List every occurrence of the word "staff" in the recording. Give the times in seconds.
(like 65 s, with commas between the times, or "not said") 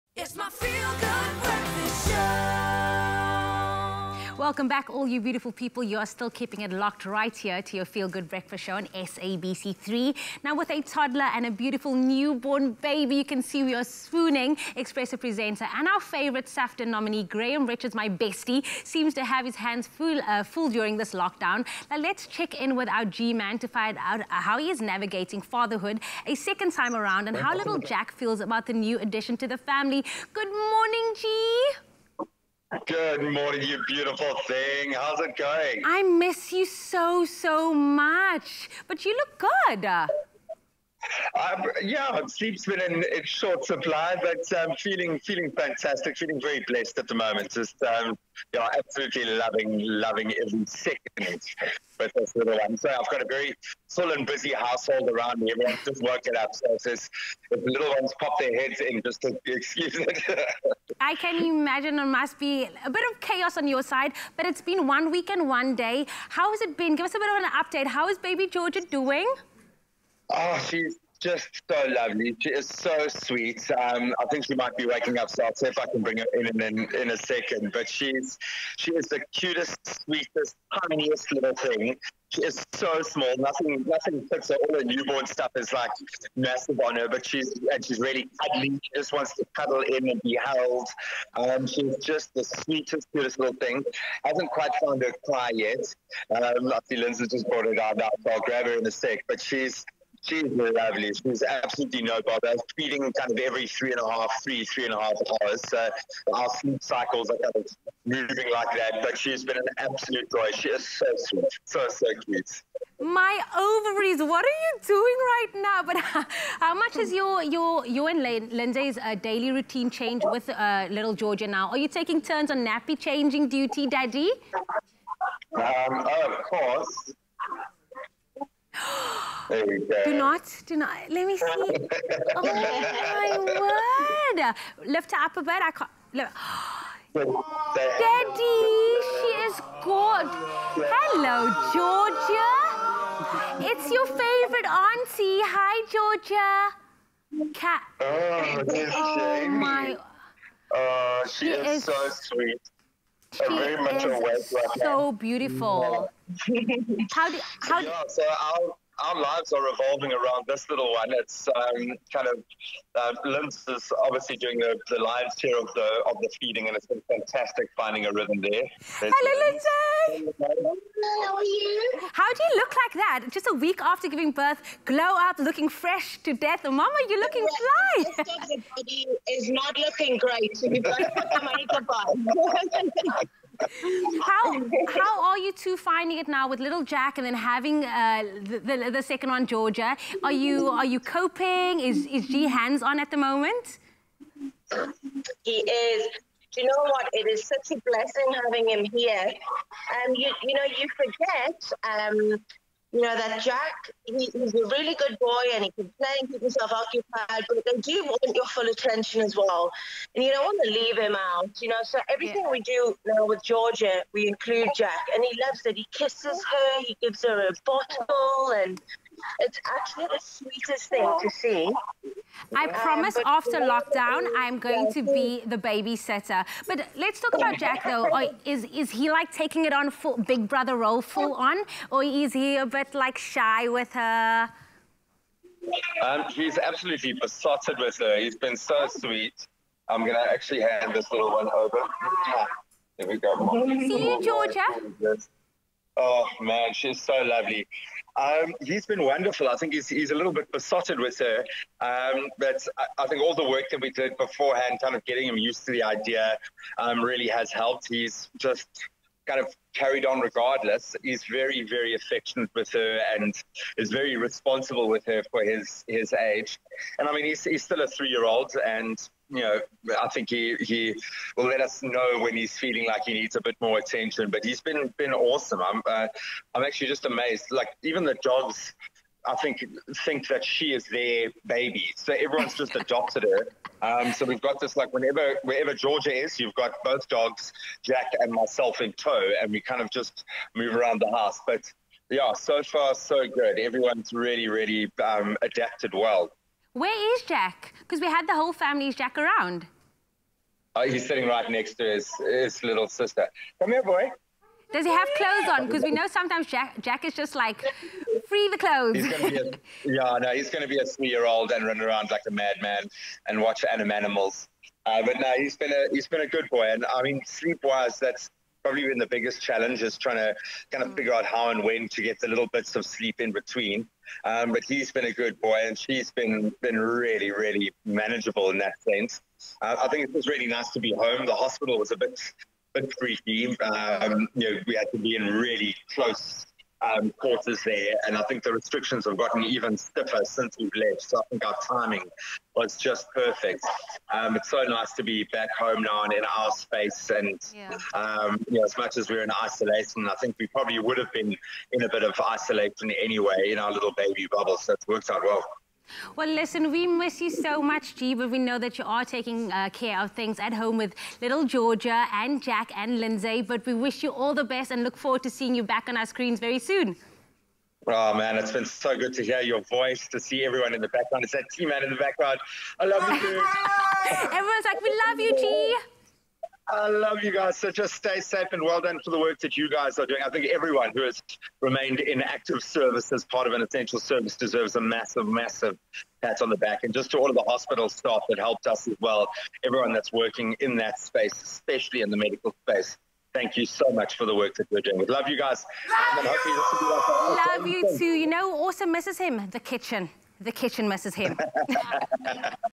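387 s.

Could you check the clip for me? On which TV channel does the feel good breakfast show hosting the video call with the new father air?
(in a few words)
SABC3.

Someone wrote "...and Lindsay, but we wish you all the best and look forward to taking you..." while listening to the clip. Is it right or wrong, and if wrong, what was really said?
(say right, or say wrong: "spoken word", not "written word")
wrong: "seeing", not "taking".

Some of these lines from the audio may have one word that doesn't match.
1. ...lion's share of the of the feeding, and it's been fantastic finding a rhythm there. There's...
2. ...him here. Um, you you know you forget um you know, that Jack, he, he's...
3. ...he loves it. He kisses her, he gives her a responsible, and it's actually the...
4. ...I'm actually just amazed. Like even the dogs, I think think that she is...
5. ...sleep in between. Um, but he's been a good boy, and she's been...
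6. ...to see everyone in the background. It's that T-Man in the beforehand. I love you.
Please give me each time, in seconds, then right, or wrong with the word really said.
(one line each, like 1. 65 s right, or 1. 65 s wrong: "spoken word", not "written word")
1. 164 s right
2. 198 s right
3. 215 s wrong: "bottle", not "responsible"
4. 276 s right
5. 322 s right
6. 370 s wrong: "background", not "beforehand".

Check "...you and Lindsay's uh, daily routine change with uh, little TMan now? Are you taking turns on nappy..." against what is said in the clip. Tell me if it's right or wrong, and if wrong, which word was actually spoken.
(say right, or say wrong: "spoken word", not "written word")
wrong: "Georgia", not "TMan".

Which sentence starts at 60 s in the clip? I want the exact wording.
I can imagine it must be a bit of chaos on your side, but it's been one week and one day.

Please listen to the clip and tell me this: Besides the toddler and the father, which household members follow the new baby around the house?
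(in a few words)
both dogs.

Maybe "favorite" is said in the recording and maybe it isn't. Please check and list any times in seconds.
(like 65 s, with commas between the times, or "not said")
15 s, 144 s.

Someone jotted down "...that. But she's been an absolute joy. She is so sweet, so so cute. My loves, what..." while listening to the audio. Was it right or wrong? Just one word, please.
wrong.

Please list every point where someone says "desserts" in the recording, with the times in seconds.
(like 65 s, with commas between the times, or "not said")
not said.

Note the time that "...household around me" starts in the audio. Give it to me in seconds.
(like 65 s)
54 s.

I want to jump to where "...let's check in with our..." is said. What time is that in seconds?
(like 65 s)
21 s.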